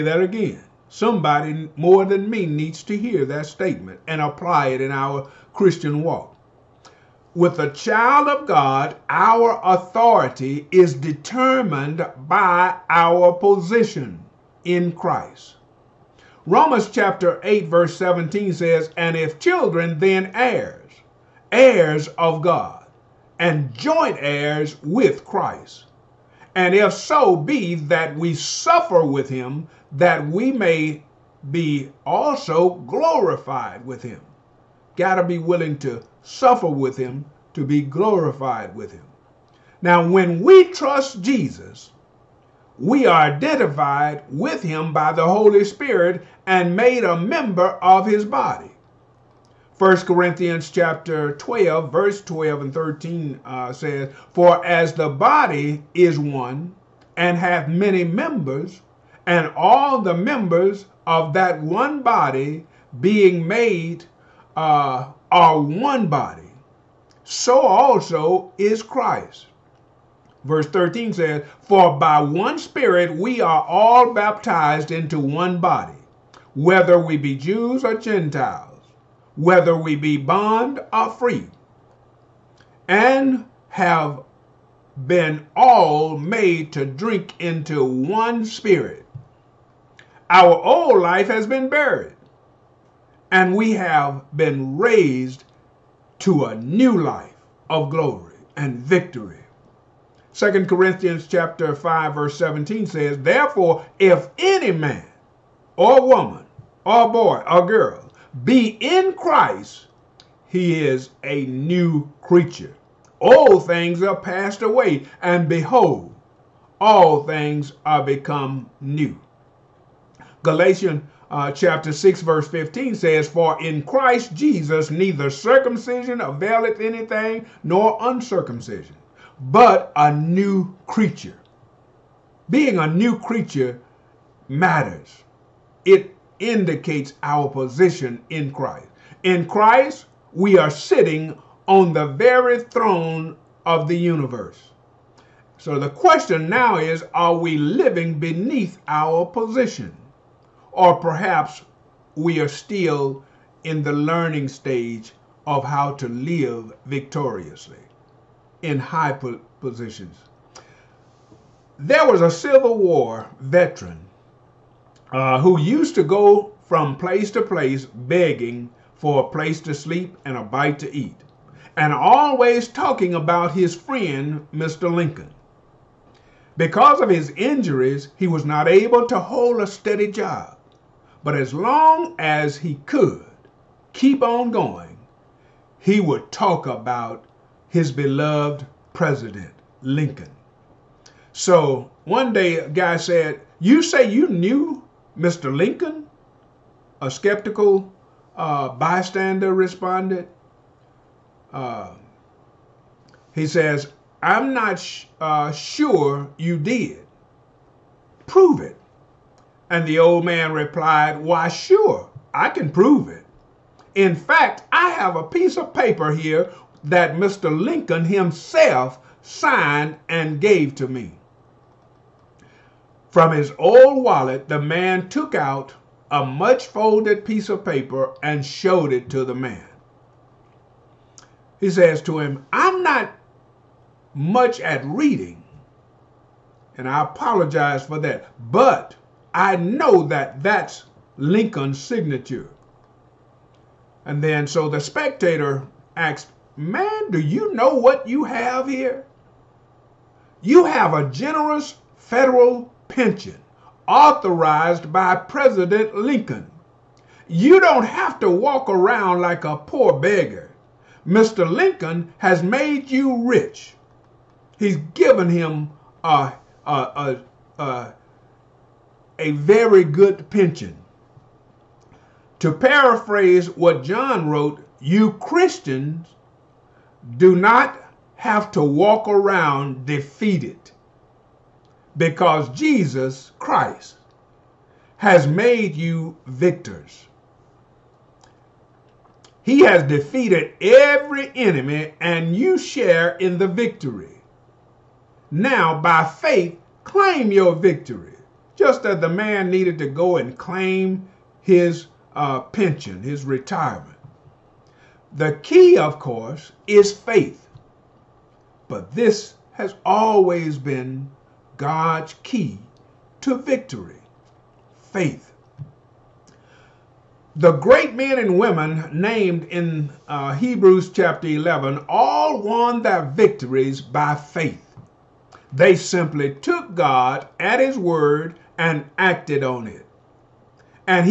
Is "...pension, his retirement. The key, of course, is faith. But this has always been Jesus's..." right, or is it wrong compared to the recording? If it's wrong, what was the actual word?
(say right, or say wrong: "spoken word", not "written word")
wrong: "God", not "Jesus".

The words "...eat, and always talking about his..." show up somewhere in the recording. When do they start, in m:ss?
2:50.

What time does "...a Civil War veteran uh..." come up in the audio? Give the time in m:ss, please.
2:42.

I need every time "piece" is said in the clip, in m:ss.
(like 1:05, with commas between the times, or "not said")
3:35, 3:47.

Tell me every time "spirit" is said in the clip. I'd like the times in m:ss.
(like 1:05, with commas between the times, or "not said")
0:45, 1:12, 1:28.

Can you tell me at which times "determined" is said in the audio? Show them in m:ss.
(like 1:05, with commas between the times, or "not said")
0:10.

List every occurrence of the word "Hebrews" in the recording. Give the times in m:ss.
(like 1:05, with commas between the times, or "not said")
5:20.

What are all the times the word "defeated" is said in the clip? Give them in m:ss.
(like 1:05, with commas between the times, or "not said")
4:39, 4:49.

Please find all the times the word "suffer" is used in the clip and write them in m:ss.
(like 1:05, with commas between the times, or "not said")
0:28, 0:36.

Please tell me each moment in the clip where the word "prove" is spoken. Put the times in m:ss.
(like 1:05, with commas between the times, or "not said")
3:28, 3:32.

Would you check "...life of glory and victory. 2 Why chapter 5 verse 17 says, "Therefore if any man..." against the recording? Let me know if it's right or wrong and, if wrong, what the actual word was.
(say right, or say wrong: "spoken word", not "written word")
wrong: "Corinthians", not "Why".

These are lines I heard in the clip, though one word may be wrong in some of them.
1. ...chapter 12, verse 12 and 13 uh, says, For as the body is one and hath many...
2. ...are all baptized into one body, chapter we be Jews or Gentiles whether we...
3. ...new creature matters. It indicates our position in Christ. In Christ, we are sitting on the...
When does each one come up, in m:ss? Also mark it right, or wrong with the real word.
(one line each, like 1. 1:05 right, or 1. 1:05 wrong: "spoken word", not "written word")
1. 0:50 right
2. 1:13 wrong: "whether", not "chapter"
3. 2:12 right.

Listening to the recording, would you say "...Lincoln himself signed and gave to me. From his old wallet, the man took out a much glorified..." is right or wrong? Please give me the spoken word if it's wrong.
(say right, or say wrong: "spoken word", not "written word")
wrong: "folded", not "glorified".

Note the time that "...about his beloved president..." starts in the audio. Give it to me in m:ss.
3:06.